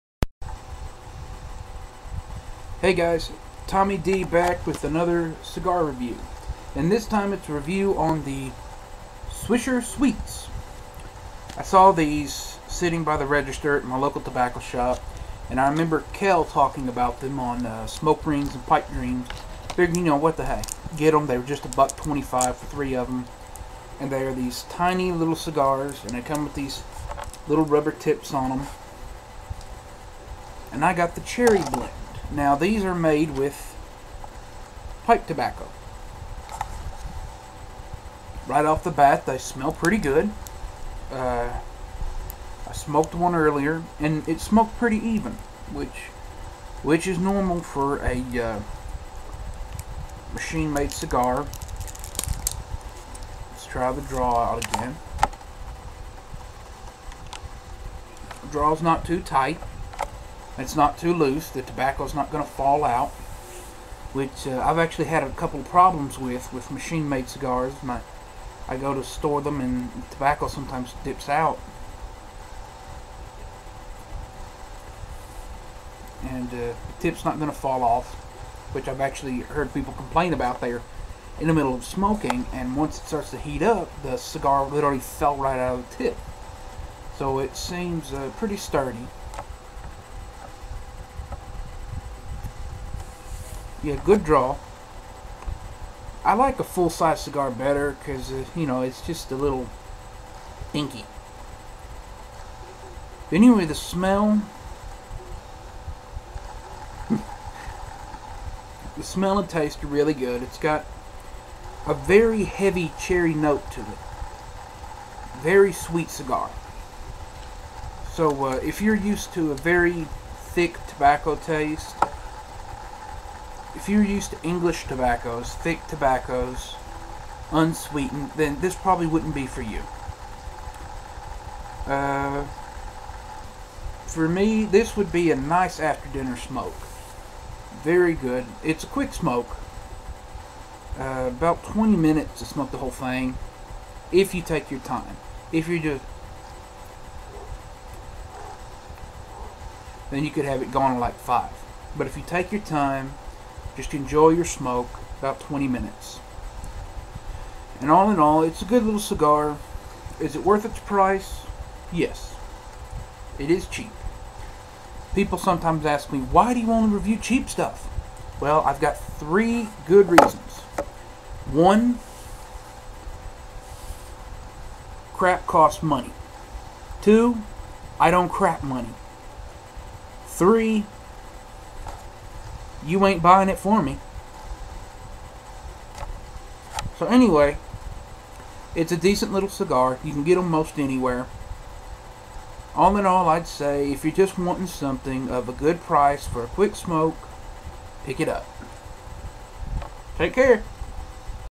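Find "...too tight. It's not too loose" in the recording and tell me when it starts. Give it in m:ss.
0:59.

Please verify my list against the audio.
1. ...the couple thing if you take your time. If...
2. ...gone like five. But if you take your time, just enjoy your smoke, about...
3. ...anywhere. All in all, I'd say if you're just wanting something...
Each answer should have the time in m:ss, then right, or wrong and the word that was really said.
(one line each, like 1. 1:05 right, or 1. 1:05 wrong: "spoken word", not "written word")
1. 2:22 wrong: "whole", not "couple"
2. 2:30 right
3. 3:10 right.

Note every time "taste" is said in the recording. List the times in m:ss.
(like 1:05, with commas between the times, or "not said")
1:49, 2:01.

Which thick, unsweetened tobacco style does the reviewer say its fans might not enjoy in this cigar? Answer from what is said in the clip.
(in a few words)
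English tobaccos.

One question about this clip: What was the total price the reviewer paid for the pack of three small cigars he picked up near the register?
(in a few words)
$1.25.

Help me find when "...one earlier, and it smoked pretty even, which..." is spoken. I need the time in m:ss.
0:43.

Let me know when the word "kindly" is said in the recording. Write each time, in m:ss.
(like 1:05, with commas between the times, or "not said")
not said.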